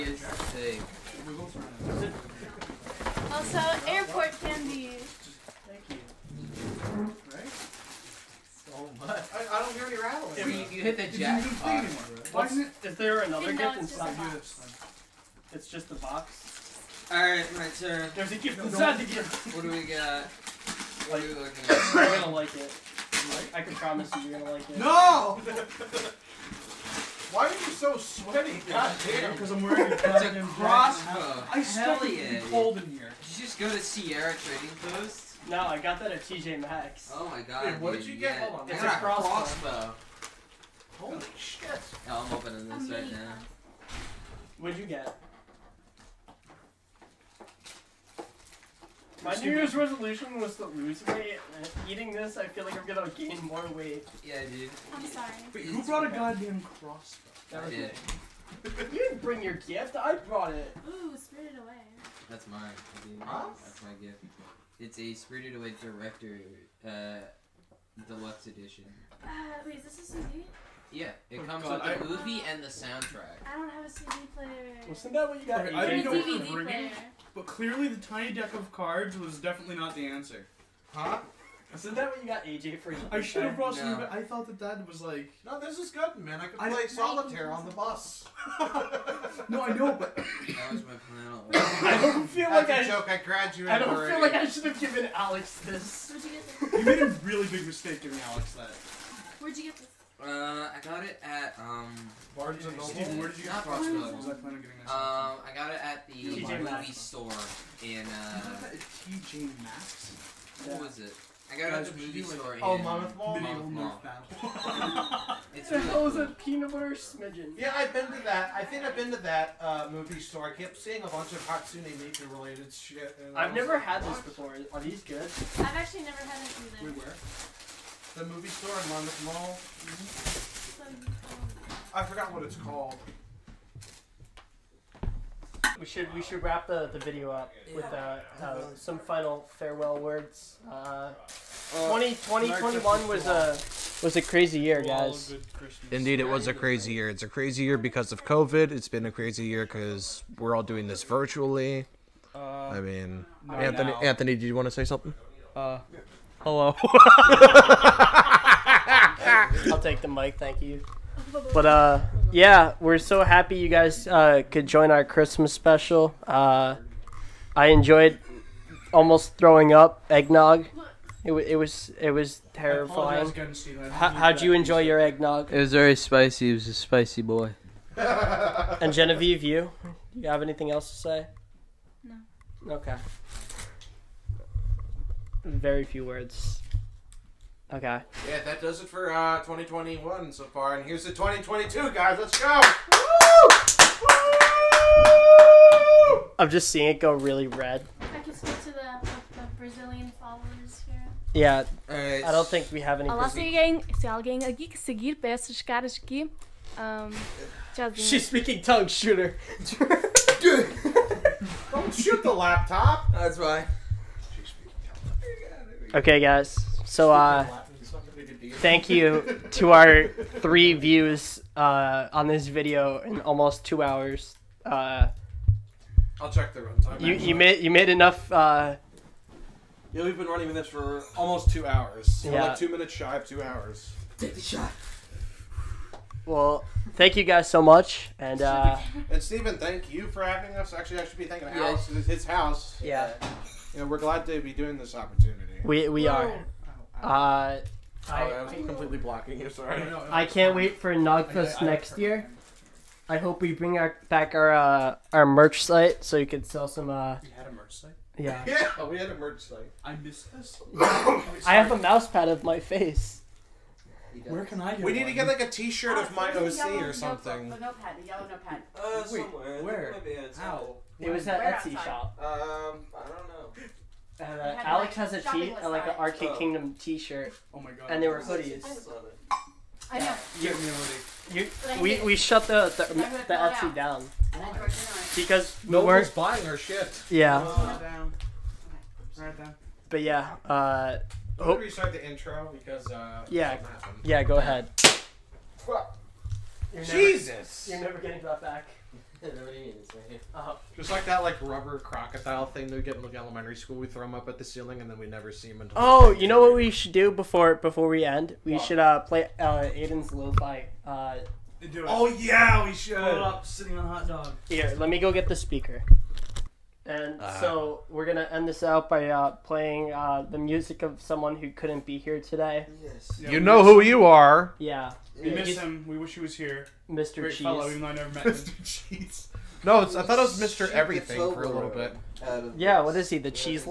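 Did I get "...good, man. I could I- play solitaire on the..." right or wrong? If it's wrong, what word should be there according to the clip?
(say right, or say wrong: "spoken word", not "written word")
right.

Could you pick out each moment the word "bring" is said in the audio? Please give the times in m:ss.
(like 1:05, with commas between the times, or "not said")
0:59, 4:13.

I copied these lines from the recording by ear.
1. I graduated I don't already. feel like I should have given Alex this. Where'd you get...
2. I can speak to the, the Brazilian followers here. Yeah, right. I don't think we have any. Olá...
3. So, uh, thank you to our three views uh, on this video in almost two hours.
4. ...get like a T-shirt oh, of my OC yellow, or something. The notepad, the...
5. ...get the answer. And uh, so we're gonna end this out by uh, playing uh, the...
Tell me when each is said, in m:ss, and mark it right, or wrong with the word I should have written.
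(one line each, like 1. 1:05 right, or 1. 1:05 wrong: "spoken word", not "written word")
1. 1:33 right
2. 3:18 right
3. 3:36 right
4. 4:25 right
5. 5:15 wrong: "speaker", not "answer".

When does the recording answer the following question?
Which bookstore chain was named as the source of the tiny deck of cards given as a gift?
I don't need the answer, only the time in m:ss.
1:42.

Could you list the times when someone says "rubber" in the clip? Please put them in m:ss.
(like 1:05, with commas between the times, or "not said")
5:01.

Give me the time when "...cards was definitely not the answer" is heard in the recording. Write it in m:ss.
1:18.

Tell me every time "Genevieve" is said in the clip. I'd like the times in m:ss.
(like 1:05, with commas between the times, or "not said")
2:58.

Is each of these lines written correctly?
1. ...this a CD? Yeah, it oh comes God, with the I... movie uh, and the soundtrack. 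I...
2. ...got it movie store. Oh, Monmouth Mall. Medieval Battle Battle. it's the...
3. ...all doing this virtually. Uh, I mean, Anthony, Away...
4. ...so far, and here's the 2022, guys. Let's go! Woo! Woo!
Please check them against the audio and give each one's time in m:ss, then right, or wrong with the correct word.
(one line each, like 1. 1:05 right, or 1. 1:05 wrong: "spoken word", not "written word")
1. 1:09 right
2. 1:51 wrong: "North", not "Battle"
3. 2:30 wrong: "Anthony", not "Away"
4. 3:10 right.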